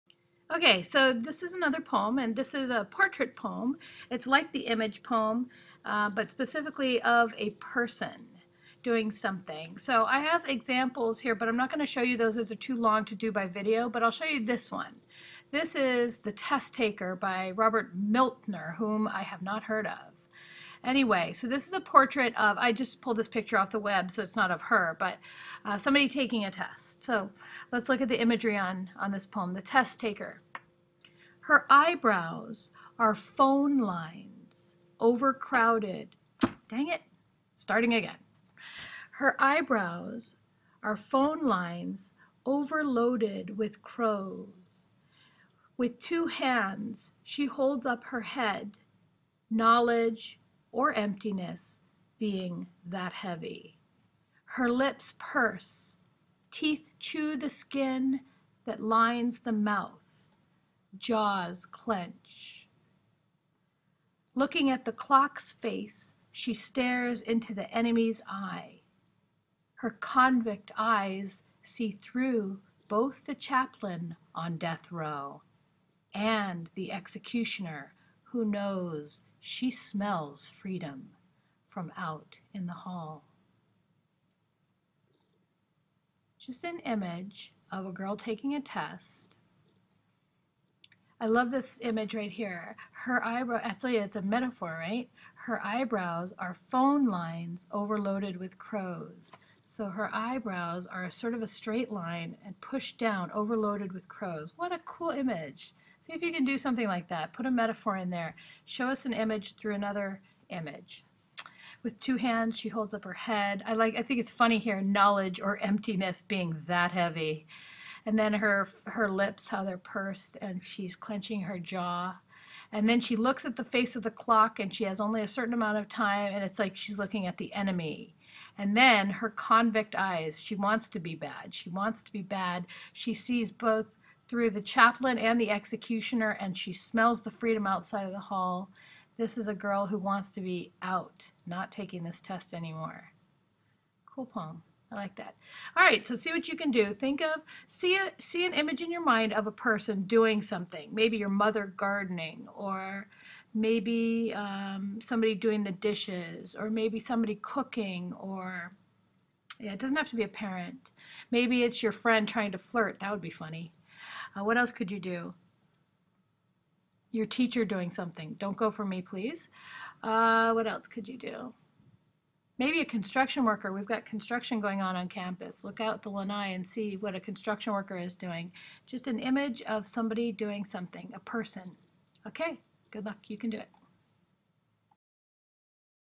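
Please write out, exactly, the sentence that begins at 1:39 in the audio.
So her eyebrows are sort of a straight line and pushed down, overloaded with crows.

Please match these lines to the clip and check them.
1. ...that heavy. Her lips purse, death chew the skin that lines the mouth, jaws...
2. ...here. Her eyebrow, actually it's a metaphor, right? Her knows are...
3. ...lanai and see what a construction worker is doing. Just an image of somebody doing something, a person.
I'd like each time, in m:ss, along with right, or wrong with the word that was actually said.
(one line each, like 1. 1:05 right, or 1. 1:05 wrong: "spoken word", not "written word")
1. 0:52 wrong: "teeth", not "death"
2. 1:32 wrong: "eyebrows", not "knows"
3. 2:56 right.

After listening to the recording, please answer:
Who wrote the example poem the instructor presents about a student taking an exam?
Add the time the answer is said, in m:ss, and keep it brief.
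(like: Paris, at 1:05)
Robert Miltner, at 0:17.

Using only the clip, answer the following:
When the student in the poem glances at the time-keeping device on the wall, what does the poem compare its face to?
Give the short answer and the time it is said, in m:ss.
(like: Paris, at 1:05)
the enemy's eye, at 1:07.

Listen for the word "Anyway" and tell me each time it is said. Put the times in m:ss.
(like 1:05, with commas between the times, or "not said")
0:20.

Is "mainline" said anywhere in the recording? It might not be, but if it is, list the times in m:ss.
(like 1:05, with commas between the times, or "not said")
not said.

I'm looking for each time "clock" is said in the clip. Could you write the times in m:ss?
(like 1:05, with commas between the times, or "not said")
1:04, 2:04.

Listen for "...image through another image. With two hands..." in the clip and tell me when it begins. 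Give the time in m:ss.
1:49.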